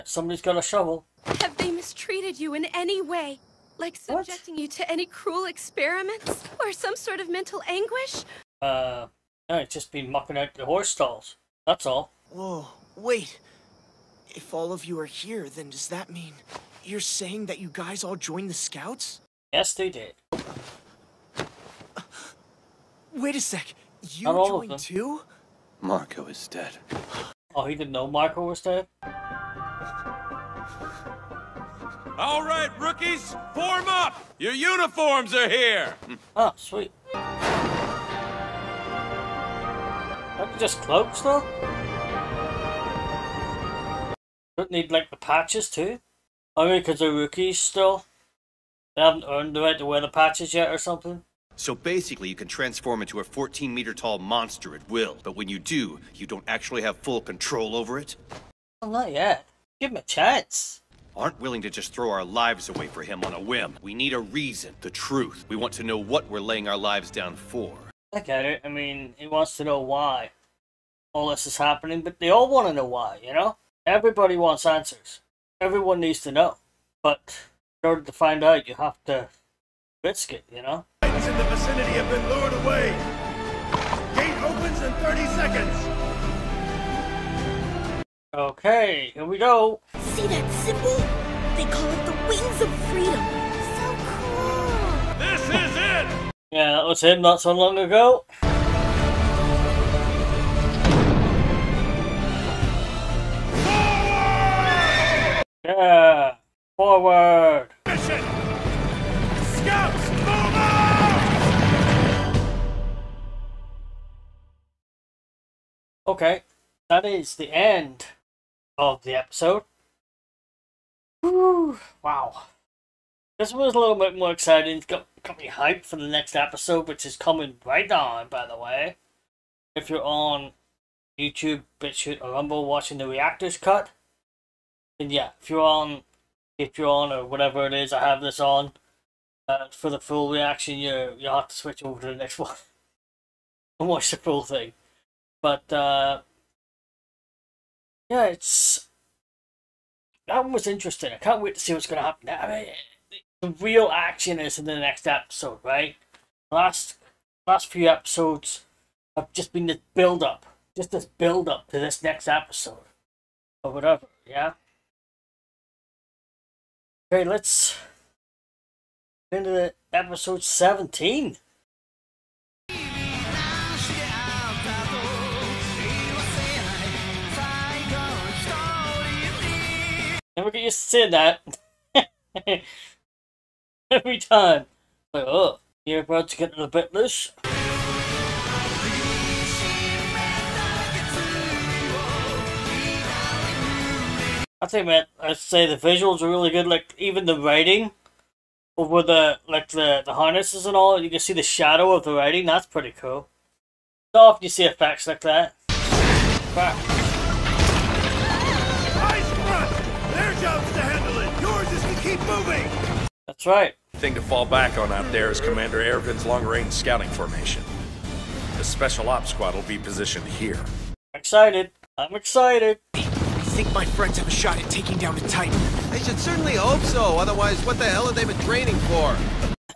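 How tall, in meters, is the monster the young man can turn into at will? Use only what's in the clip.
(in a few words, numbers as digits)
14 meters.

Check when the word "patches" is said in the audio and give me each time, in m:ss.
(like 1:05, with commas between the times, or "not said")
0:45, 0:50.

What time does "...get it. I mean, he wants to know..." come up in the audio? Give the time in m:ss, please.
1:08.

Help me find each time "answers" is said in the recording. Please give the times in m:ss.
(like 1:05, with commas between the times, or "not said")
1:14.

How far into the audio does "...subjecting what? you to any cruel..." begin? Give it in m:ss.
0:03.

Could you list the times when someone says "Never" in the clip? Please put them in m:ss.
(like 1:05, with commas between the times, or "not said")
3:00.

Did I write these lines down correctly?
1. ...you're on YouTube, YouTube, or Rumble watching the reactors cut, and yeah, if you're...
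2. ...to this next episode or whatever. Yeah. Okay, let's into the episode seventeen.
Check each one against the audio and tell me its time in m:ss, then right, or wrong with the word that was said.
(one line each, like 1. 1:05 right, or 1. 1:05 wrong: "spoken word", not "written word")
1. 2:09 wrong: "BitChute", not "YouTube"
2. 2:41 right.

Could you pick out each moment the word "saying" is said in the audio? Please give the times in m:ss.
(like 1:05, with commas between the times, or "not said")
0:17, 3:00.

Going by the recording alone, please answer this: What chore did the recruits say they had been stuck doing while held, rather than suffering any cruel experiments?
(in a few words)
Mucking out the horse stalls.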